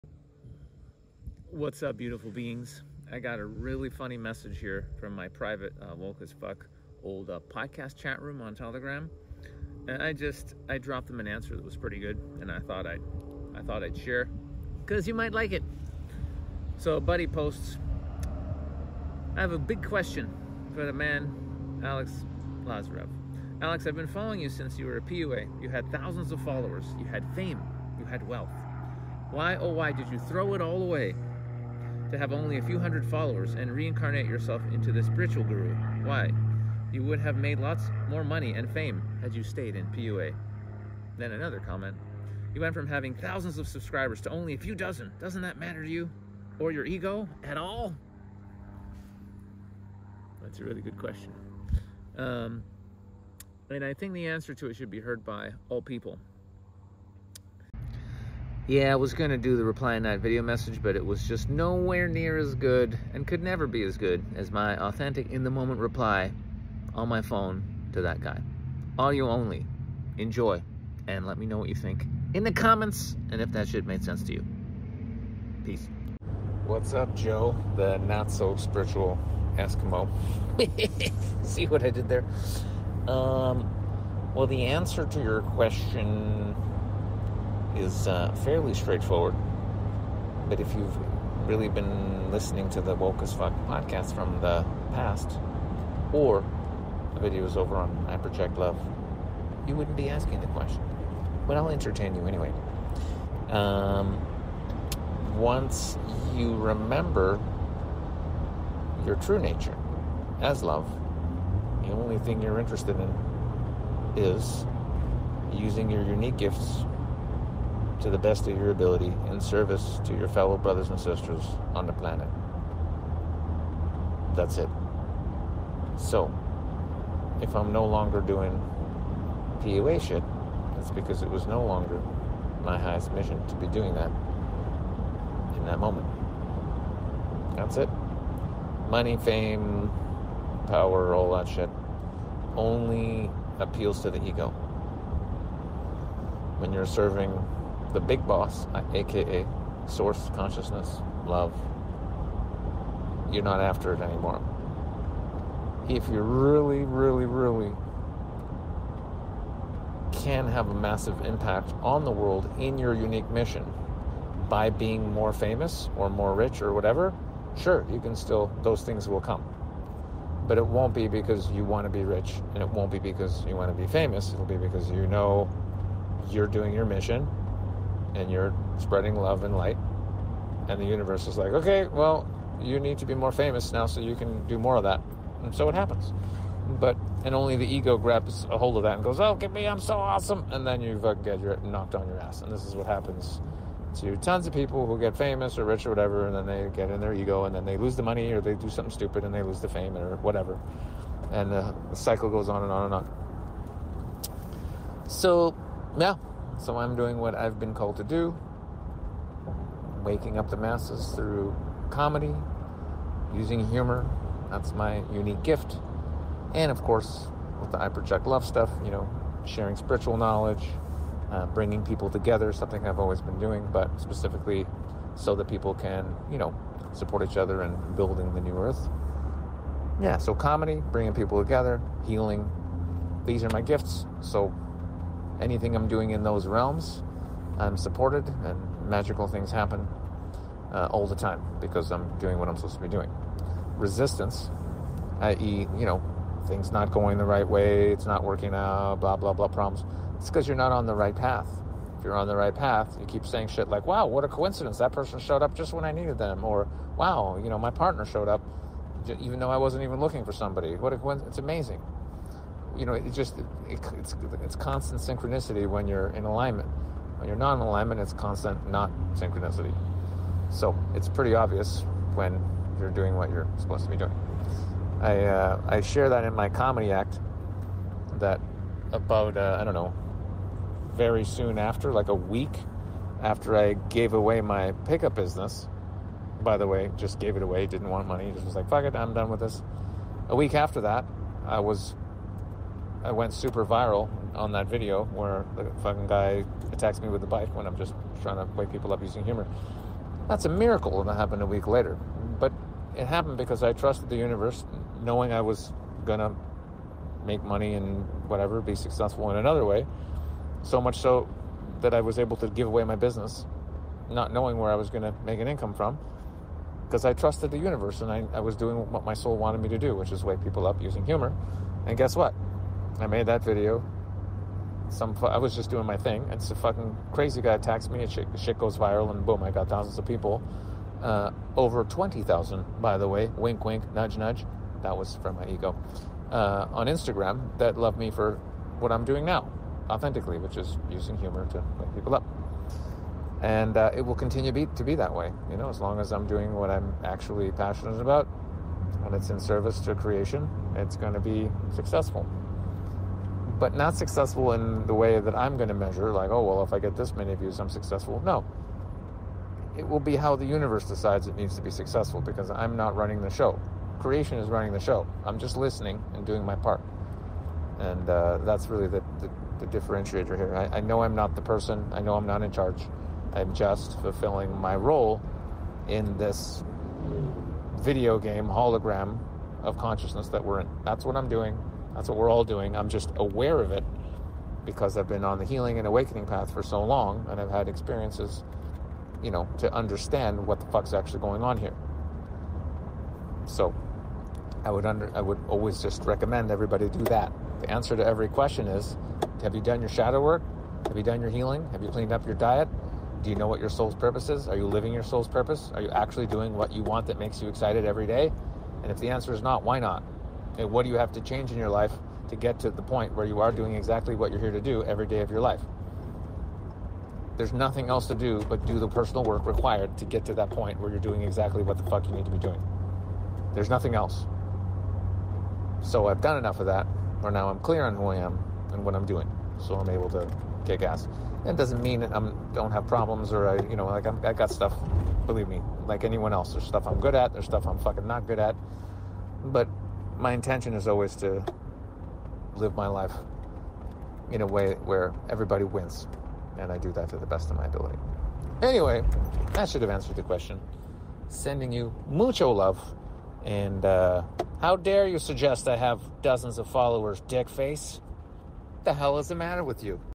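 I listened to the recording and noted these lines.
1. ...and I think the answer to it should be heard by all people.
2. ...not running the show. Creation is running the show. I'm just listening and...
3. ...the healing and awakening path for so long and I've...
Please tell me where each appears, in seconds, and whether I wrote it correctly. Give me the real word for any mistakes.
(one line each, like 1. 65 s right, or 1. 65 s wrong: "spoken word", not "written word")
1. 53 s right
2. 362 s right
3. 385 s right.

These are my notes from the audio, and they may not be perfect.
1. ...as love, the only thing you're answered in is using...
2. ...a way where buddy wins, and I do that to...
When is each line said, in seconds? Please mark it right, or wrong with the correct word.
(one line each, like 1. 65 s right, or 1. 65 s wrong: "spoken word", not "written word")
1. 110 s wrong: "interested", not "answered"
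2. 444 s wrong: "everybody", not "buddy".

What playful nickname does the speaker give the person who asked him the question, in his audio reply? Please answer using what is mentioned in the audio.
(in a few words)
the not so spiritual Eskimo.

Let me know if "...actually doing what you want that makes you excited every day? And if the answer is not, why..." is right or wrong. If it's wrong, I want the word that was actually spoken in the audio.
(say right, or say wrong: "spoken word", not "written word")
right.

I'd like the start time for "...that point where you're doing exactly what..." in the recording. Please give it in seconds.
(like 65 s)
420 s.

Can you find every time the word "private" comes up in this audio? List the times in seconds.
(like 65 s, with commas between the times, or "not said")
5 s.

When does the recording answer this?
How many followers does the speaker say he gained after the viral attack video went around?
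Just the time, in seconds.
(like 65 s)
331 s.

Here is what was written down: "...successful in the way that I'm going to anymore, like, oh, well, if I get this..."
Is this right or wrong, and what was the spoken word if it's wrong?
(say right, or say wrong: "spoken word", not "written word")
wrong: "measure", not "anymore".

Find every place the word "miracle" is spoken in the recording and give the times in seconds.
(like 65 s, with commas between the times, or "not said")
300 s.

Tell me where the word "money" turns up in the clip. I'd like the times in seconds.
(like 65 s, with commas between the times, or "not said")
38 s, 138 s, 198 s, 288 s, 307 s.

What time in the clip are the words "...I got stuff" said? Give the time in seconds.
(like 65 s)
434 s.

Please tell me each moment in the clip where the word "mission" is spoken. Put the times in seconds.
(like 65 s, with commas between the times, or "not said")
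133 s, 163 s, 176 s.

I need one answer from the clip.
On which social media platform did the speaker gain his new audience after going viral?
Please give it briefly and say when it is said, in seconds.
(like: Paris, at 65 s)
Instagram, at 336 s.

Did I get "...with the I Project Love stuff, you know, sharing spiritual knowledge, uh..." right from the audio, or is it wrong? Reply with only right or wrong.
right.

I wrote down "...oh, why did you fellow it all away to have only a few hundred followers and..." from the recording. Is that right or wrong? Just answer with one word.
wrong.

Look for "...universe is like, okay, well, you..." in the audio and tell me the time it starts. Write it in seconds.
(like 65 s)
180 s.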